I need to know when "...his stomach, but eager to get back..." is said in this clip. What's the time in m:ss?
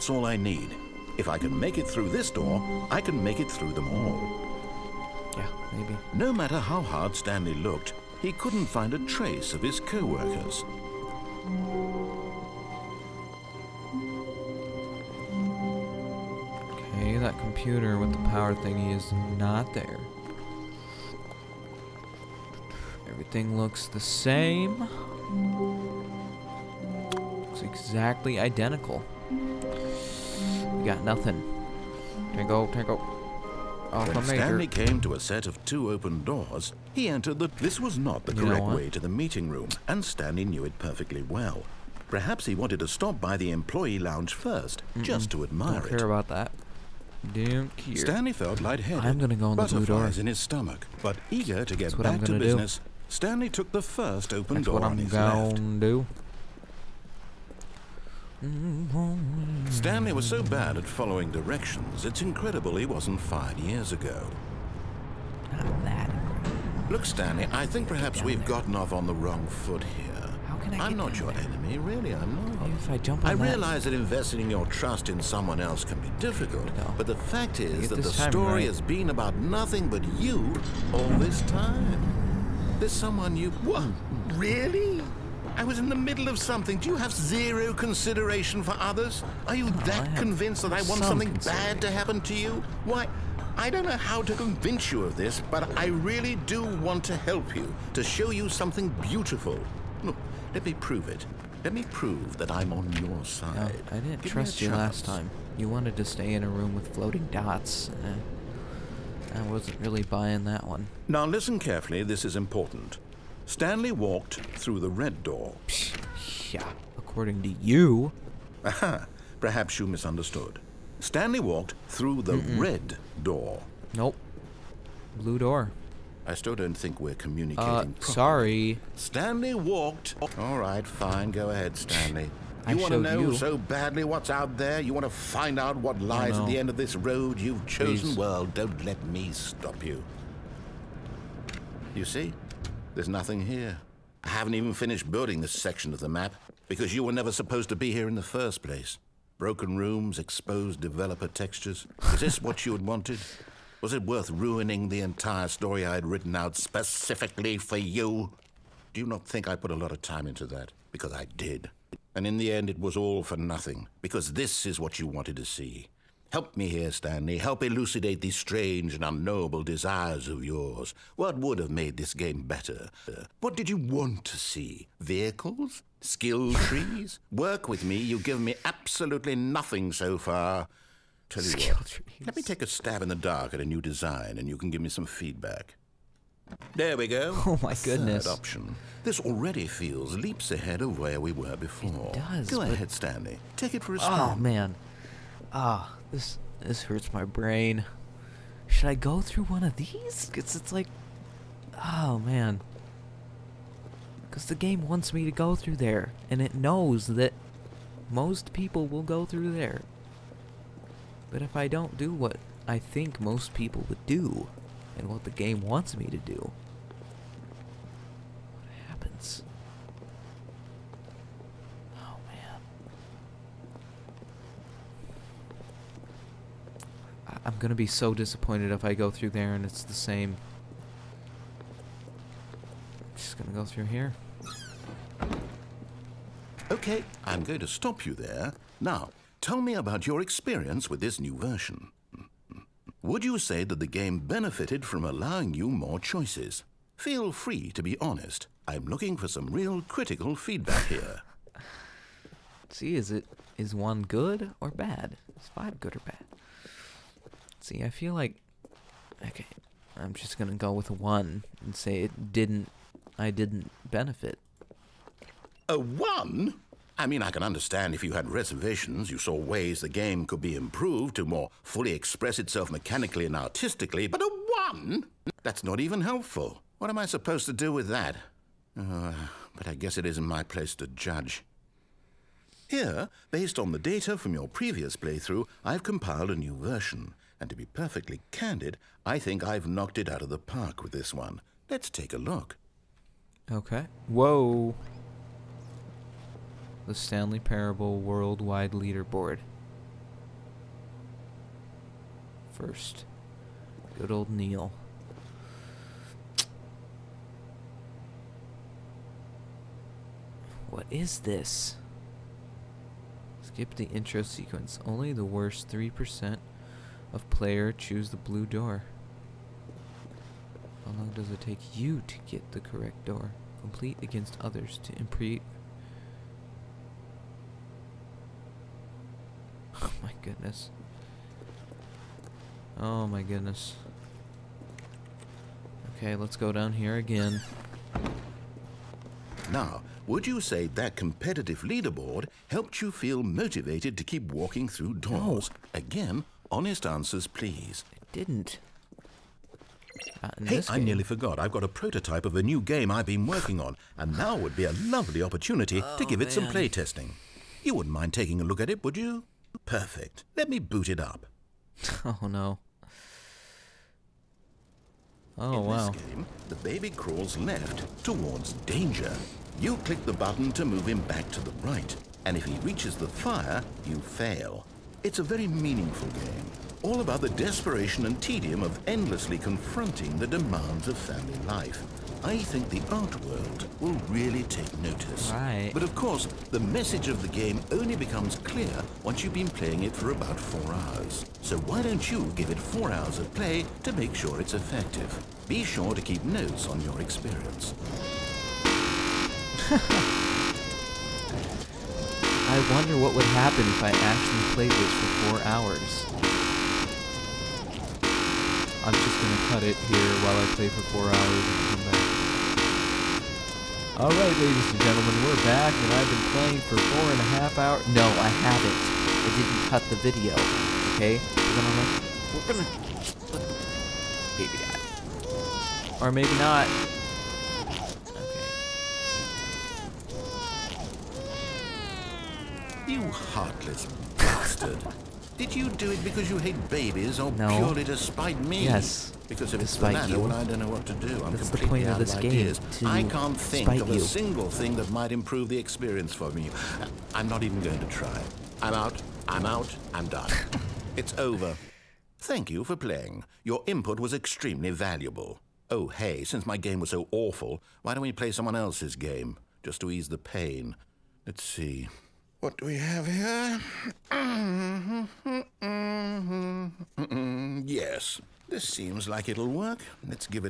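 0:50.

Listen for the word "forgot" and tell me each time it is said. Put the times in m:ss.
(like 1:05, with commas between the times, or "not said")
5:51.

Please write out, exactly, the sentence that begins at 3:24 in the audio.
Because the game wants me to go through there, and it knows that most people will go through there.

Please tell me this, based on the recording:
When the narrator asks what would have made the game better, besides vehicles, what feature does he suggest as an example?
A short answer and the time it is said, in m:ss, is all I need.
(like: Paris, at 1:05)
Skill trees, at 2:56.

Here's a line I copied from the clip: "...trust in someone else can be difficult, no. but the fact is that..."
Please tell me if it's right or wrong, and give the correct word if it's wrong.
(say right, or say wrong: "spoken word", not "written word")
right.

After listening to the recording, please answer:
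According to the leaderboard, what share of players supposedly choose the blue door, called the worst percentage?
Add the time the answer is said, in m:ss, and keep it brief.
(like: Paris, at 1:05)
3%, at 5:15.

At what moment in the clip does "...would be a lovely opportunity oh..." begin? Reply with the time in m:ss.
5:54.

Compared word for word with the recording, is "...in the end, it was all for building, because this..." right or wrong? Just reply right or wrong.
wrong.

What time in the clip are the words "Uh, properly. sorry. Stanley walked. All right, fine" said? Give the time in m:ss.
2:07.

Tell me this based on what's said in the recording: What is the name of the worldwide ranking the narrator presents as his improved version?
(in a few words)
Stanley Parable Worldwide Leaderboard.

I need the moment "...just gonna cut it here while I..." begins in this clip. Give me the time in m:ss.
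6:48.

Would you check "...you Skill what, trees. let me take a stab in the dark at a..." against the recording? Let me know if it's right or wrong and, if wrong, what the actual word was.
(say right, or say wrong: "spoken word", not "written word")
right.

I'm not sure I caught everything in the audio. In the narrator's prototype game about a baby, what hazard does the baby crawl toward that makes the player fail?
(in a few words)
The fire.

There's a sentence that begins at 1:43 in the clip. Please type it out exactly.
No, I didn't Give trust you chance.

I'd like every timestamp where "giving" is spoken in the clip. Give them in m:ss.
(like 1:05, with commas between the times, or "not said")
not said.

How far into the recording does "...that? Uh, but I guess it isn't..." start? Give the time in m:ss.
4:37.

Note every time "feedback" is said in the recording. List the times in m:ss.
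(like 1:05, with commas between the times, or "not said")
3:05, 4:10.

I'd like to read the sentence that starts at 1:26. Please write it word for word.
Do you have zero consideration for others?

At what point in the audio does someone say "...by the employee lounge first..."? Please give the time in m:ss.
0:43.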